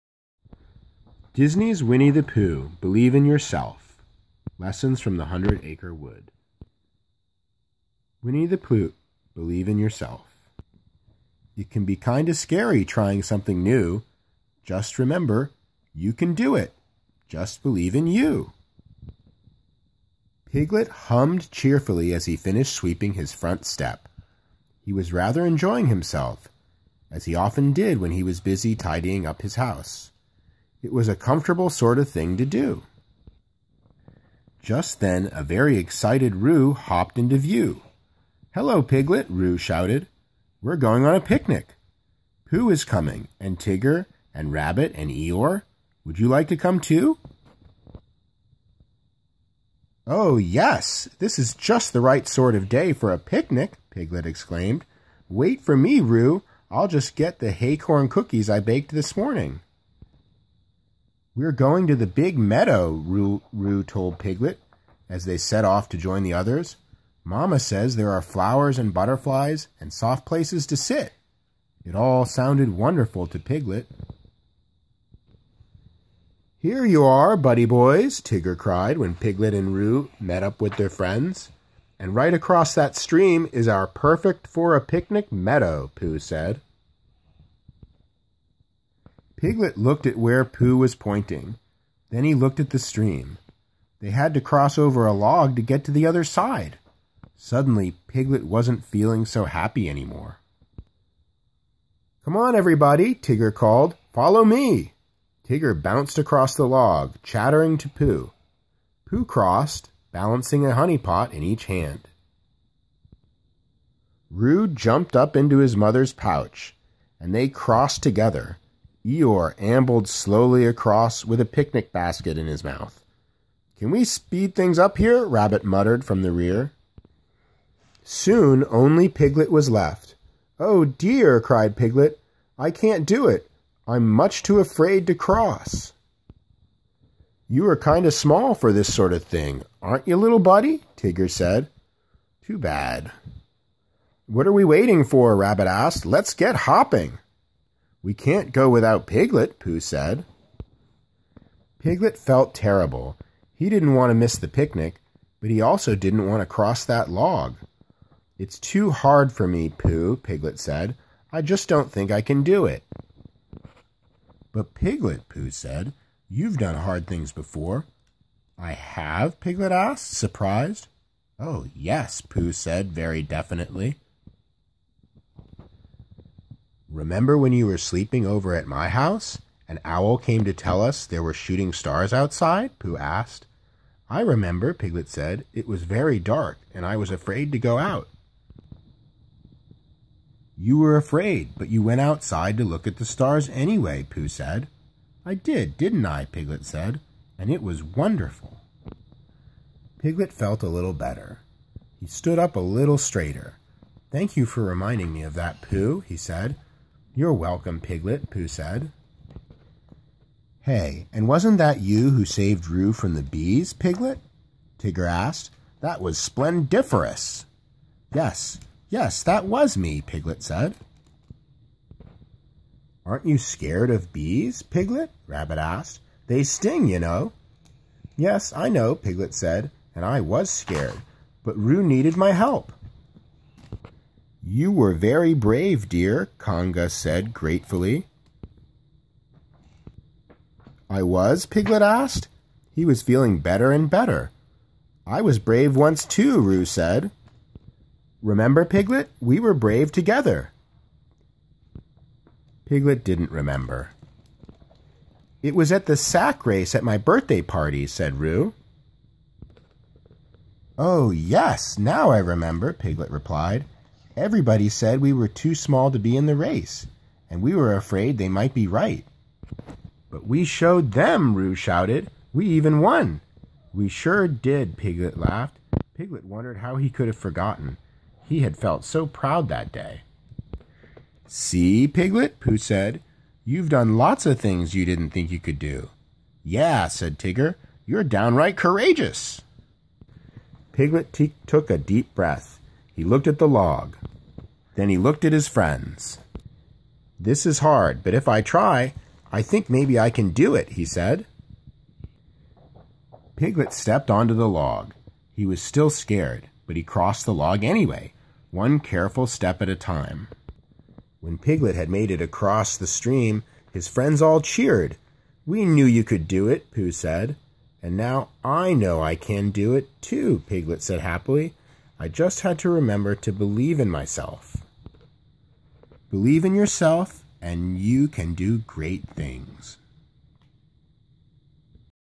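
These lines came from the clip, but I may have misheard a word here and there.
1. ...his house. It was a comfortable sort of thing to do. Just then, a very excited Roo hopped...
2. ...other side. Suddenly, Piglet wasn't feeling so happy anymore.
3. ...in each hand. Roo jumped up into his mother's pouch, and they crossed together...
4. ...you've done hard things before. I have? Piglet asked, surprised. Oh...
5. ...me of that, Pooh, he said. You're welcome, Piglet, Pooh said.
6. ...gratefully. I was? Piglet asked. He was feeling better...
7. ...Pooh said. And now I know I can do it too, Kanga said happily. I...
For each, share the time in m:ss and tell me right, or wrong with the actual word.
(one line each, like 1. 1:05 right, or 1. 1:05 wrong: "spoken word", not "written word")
1. 0:29 right
2. 1:36 right
3. 1:51 right
4. 2:46 right
5. 3:25 right
6. 3:57 right
7. 5:16 wrong: "Piglet", not "Kanga".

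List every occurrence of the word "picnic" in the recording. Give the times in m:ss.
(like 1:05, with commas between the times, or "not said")
0:41, 0:53, 1:24, 2:01, 2:34.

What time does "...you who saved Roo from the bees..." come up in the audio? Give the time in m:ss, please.
3:31.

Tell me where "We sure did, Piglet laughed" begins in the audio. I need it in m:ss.
4:33.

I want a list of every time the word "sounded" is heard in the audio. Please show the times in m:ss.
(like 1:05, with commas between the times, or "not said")
1:12.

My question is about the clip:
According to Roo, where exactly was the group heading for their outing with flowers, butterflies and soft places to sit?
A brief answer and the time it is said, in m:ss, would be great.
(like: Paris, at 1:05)
the big meadow, at 1:01.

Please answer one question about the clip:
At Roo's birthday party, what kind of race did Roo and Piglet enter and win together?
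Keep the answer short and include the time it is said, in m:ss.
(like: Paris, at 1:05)
sack race, at 4:15.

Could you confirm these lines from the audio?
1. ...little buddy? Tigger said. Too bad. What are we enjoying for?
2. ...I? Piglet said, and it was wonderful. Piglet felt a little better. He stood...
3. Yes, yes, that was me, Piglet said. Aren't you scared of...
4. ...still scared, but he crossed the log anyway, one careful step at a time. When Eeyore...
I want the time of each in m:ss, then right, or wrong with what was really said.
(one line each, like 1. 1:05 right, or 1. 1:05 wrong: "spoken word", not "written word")
1. 2:20 wrong: "waiting", not "enjoying"
2. 3:16 right
3. 3:38 right
4. 5:05 wrong: "Piglet", not "Eeyore".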